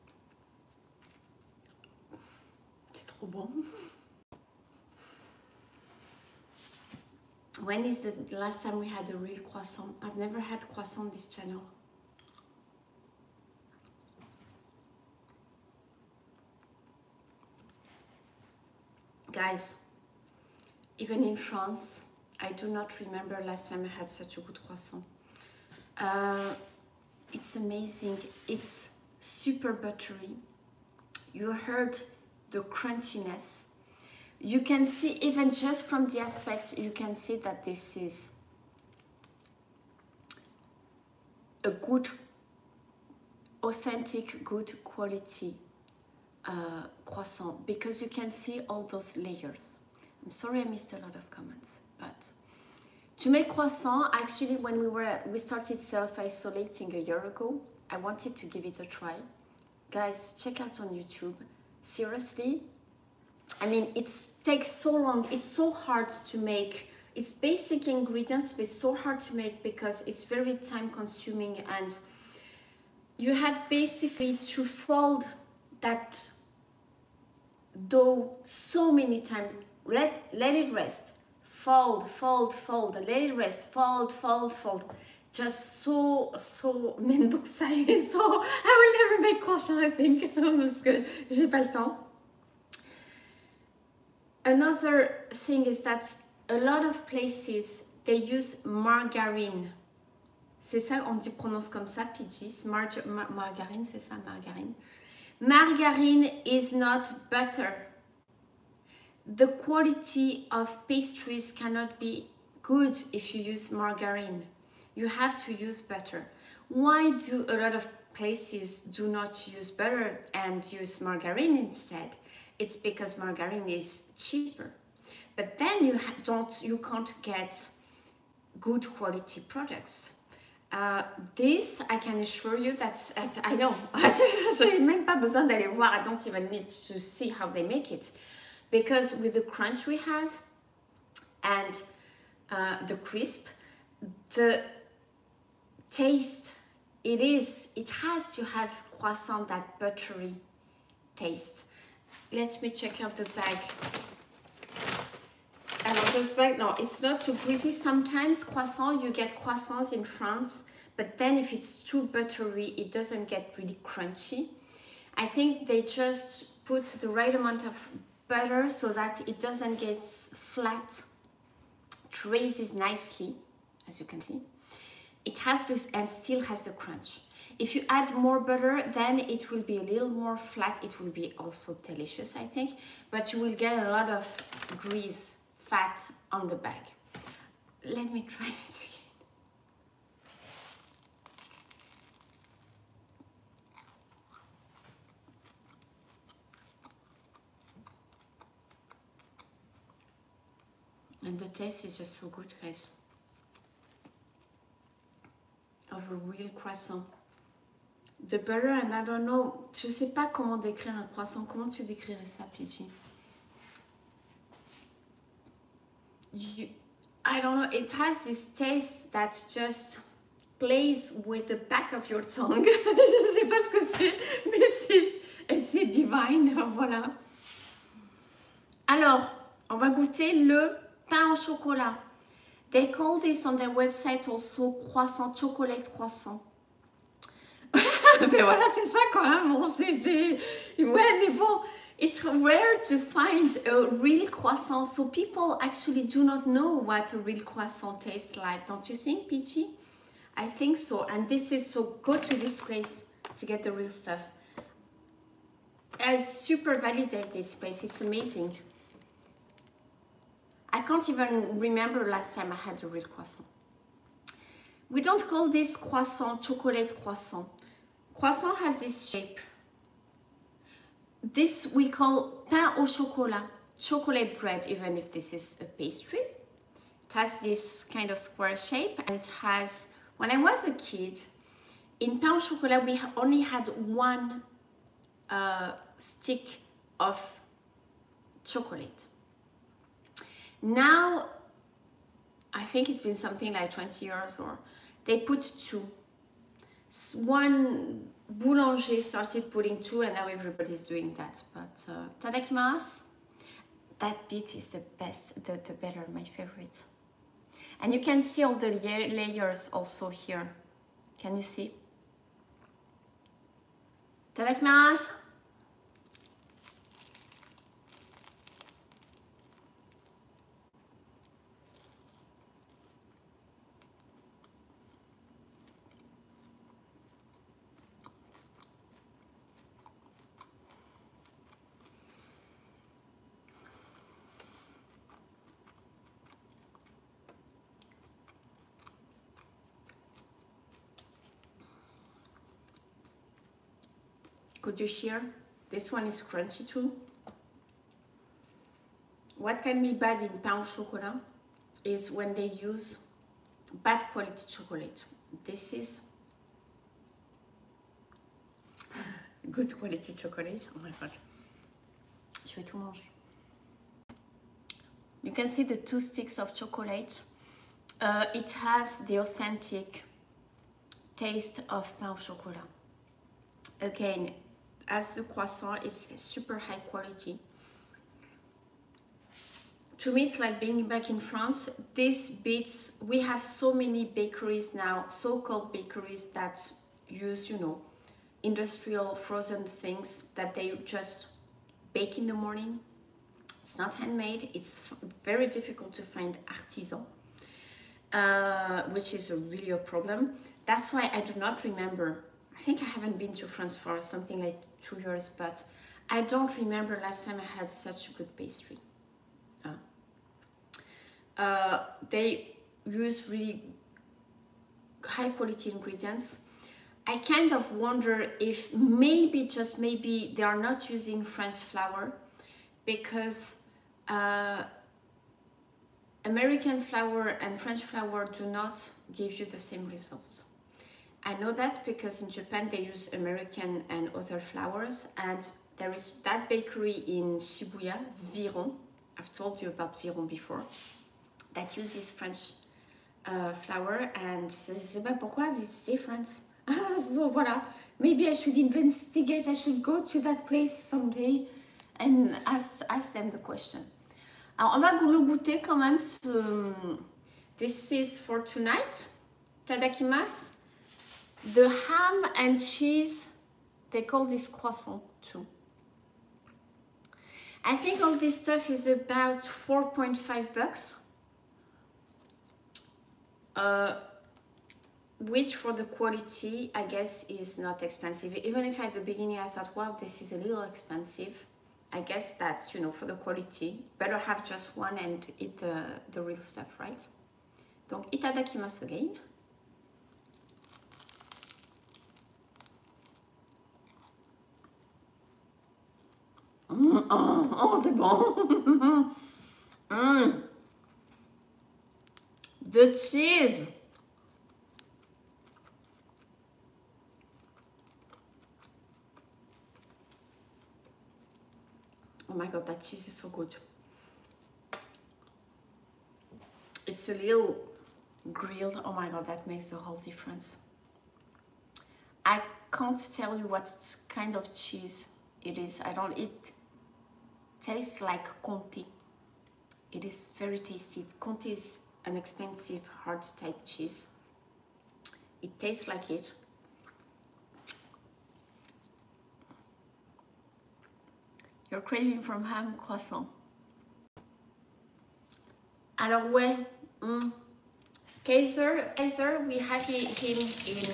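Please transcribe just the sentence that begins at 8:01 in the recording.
I guess that's, you know, for the quality.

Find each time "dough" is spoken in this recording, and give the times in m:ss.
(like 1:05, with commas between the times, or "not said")
1:17.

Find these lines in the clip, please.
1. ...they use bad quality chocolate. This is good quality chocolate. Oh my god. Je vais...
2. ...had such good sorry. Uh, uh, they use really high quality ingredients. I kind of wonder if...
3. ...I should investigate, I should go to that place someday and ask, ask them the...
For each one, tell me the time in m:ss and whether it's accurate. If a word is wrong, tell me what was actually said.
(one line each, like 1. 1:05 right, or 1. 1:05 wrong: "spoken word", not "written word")
1. 5:52 right
2. 6:47 wrong: "pastry", not "sorry"
3. 7:28 right.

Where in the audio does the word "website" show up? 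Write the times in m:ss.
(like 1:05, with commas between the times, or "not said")
3:53.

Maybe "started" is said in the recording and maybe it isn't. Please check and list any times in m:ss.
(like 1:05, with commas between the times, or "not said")
0:55, 4:59.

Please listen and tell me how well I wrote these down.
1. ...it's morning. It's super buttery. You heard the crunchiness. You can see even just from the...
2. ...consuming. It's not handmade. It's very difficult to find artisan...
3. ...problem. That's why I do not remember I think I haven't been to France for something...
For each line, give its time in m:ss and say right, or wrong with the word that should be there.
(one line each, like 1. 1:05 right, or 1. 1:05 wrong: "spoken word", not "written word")
1. 0:27 wrong: "amazing", not "morning"
2. 6:32 wrong: "morning", not "consuming"
3. 6:39 right.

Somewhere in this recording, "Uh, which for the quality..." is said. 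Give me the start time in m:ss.
7:53.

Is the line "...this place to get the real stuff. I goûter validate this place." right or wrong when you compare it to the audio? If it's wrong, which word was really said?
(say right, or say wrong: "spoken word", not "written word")
wrong: "super", not "goûter".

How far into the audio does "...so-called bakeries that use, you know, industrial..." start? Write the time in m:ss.
6:25.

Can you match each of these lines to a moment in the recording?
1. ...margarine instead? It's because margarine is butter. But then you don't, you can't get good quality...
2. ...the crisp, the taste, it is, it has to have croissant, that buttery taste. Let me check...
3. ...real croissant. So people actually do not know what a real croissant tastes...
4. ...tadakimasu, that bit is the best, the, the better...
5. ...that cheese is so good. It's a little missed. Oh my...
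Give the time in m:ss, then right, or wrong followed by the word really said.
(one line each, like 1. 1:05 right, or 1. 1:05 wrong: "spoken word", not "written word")
1. 2:01 wrong: "cheaper", not "butter"
2. 2:22 right
3. 4:04 right
4. 5:02 right
5. 8:32 wrong: "grilled", not "missed".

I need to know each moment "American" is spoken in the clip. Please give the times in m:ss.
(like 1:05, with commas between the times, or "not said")
7:06, 7:13.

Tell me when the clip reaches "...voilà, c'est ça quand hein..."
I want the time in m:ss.
3:58.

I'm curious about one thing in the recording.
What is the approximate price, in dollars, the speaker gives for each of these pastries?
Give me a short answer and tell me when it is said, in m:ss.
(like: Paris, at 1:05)
$4.50, at 7:49.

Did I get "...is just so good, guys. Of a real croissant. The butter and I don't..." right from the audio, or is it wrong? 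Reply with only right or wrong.
right.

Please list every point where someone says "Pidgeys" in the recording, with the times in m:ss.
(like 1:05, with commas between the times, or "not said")
1:42, 3:32.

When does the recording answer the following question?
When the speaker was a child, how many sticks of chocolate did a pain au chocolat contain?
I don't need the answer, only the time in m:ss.
4:44.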